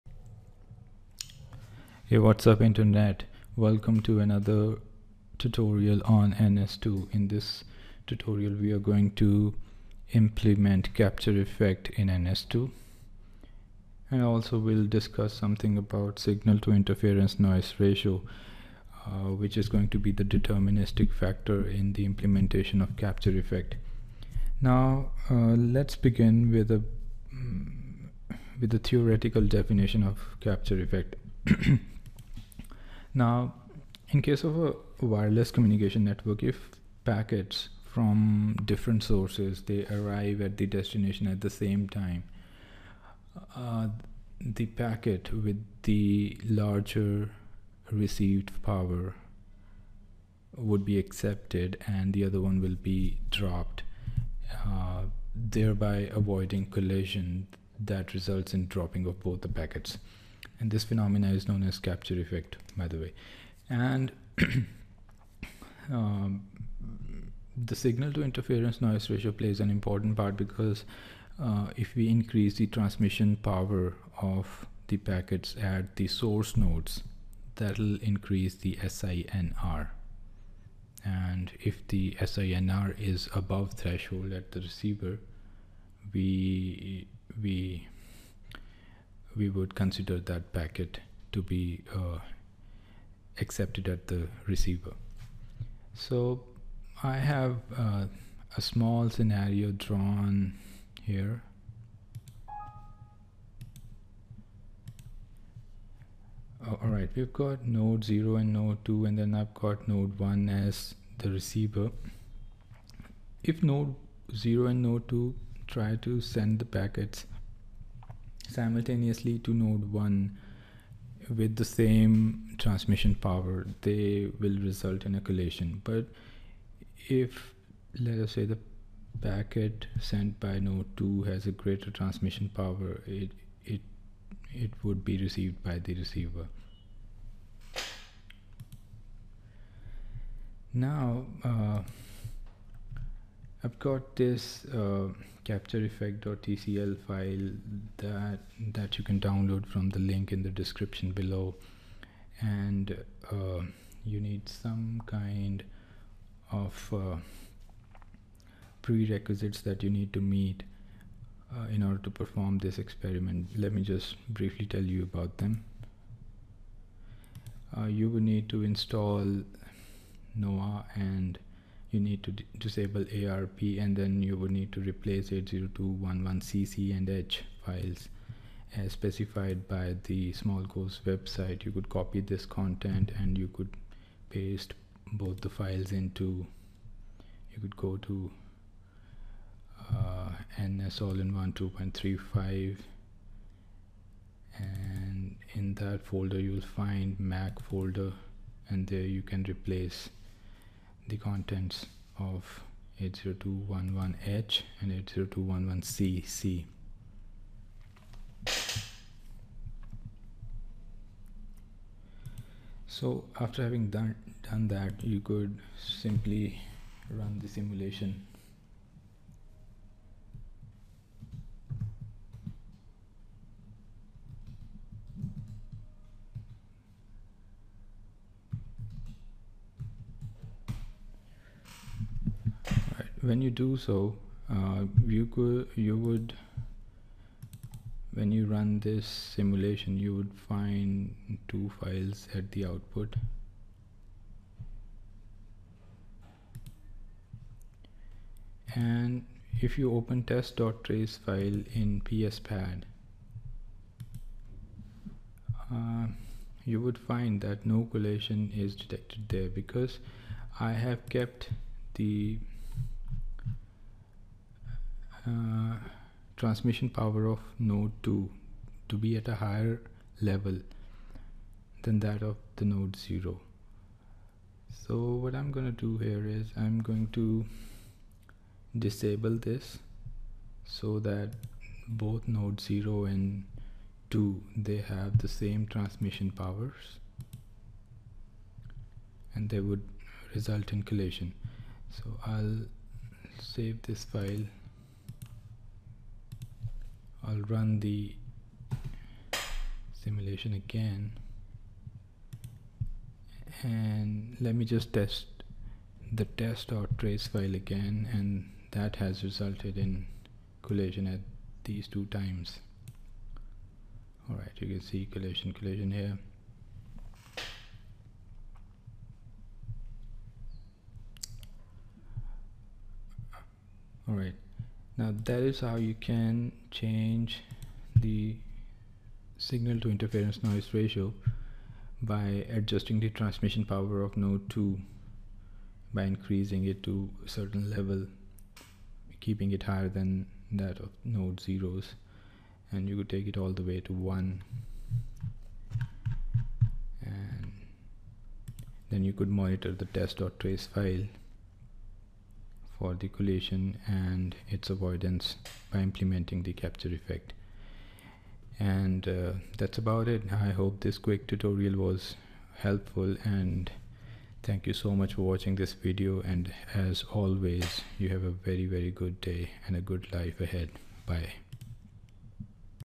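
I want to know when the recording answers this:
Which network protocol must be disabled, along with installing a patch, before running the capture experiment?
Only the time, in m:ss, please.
2:53.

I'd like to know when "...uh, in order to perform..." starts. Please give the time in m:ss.
2:41.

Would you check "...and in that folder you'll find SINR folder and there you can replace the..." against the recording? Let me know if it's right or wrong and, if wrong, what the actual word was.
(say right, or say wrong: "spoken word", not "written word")
wrong: "Mac", not "SINR".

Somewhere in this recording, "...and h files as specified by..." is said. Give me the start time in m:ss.
2:56.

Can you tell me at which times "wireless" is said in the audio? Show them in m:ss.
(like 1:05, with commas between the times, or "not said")
0:35.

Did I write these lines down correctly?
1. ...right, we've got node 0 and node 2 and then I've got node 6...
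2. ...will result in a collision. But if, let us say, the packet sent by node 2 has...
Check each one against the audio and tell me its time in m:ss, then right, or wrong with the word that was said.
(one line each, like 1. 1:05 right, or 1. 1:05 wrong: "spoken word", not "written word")
1. 1:46 wrong: "1", not "6"
2. 2:04 right.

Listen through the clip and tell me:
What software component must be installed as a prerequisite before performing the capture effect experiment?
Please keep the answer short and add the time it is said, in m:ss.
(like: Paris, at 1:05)
NOAH, at 2:50.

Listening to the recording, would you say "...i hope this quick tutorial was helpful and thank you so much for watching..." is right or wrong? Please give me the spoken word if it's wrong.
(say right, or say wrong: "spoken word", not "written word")
right.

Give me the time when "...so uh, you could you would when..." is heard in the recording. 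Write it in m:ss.
3:53.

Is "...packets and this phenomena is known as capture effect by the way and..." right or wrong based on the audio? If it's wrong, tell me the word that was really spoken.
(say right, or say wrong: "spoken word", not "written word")
right.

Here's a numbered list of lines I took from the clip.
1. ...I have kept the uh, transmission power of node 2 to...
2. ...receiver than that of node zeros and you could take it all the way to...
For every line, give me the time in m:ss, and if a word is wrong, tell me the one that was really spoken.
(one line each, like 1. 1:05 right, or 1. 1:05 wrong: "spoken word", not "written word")
1. 4:20 right
2. 5:39 wrong: "higher", not "receiver".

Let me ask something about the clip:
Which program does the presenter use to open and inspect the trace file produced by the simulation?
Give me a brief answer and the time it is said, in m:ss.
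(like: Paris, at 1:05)
PSPad, at 4:12.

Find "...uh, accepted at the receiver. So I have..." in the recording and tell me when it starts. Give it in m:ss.
1:31.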